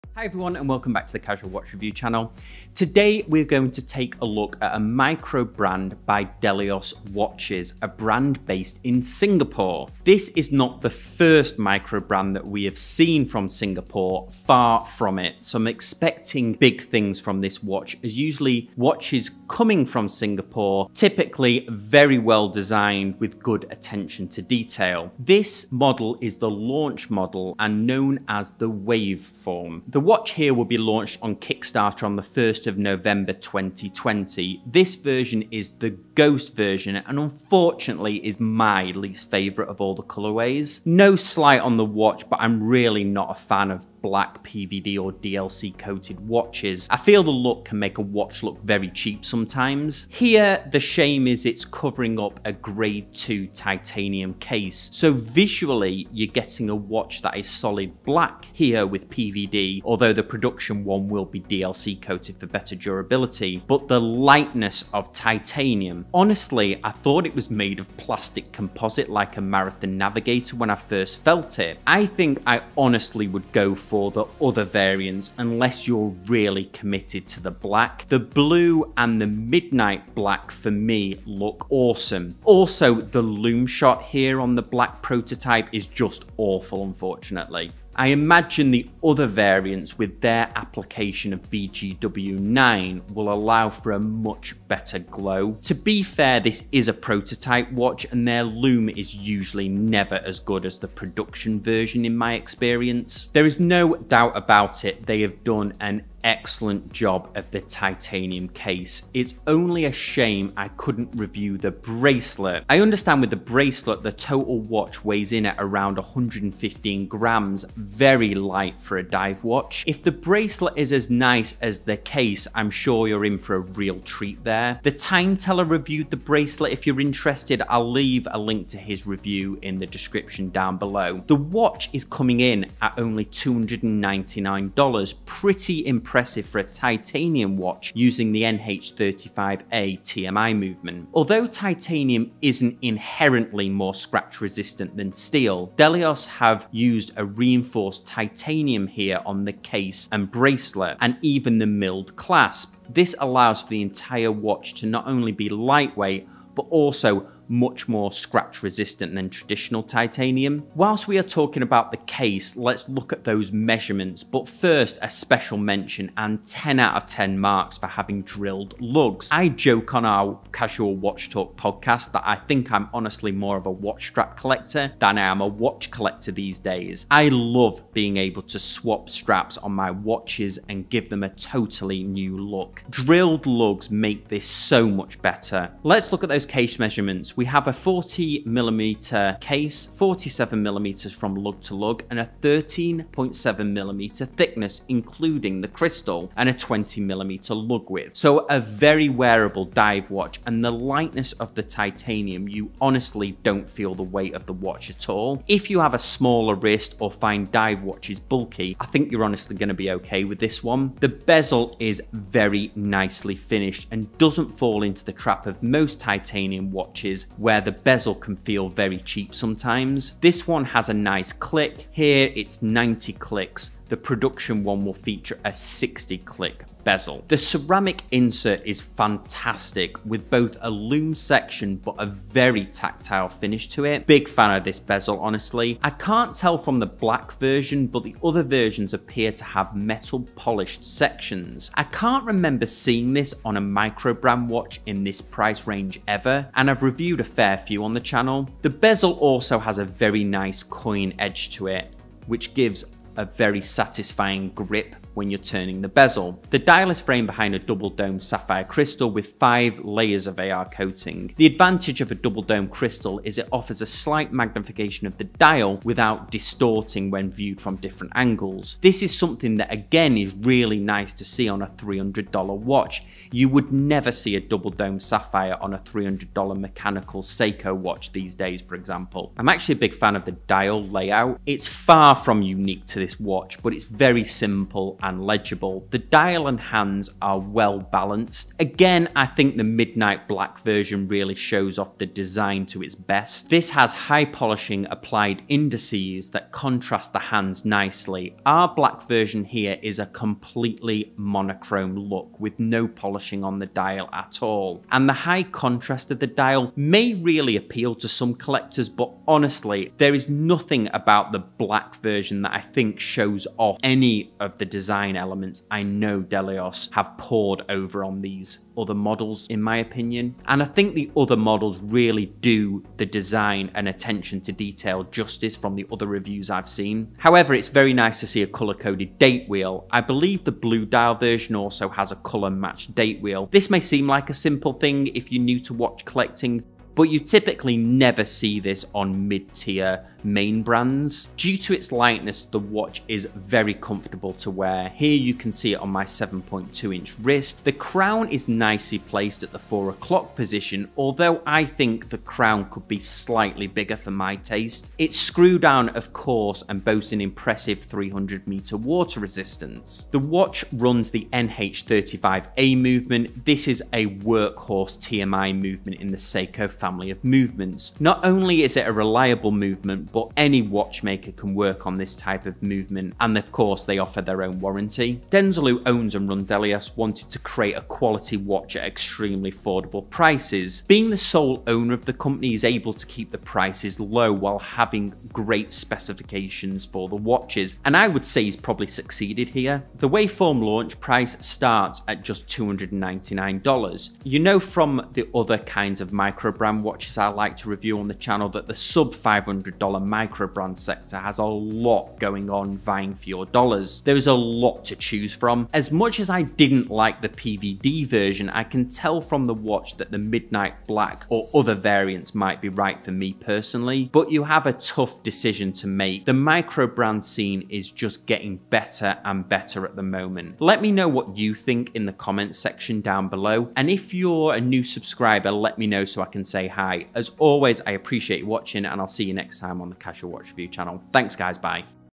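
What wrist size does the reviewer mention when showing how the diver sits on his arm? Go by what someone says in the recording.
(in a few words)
7.2 inch.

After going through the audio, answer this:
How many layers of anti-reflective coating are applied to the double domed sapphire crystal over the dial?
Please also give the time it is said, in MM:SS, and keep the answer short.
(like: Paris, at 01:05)
5, at 04:19.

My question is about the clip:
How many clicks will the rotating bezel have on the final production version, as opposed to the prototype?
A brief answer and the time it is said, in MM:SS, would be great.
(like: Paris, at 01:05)
60, at 03:45.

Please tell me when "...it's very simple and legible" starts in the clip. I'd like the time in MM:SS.
04:43.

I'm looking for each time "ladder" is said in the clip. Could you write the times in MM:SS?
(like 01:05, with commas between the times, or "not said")
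not said.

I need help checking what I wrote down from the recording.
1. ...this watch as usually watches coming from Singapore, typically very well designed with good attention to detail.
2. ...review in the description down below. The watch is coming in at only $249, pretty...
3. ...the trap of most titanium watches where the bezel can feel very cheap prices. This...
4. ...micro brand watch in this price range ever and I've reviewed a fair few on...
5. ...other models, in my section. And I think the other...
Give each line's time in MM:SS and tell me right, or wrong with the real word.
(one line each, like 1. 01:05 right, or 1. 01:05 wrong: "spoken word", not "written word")
1. 00:17 right
2. 02:09 wrong: "299", not "249"
3. 03:35 wrong: "sometimes", not "prices"
4. 04:03 right
5. 05:18 wrong: "opinion", not "section".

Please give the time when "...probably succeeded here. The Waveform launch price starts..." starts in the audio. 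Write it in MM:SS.
06:28.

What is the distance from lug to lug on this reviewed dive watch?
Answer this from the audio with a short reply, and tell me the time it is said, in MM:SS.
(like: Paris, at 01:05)
47 millimeters, at 03:09.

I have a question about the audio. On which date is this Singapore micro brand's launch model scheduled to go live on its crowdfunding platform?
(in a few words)
1st of November 2020.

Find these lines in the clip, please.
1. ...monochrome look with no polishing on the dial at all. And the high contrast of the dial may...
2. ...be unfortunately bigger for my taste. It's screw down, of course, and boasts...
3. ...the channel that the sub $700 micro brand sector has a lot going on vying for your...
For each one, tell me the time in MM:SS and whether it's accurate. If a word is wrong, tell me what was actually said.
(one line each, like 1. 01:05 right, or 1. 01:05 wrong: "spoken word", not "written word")
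1. 05:01 right
2. 05:52 wrong: "slightly", not "unfortunately"
3. 06:38 wrong: "500", not "700".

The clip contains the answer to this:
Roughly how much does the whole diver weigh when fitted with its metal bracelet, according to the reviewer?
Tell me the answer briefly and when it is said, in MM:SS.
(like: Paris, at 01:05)
115 grams, at 01:55.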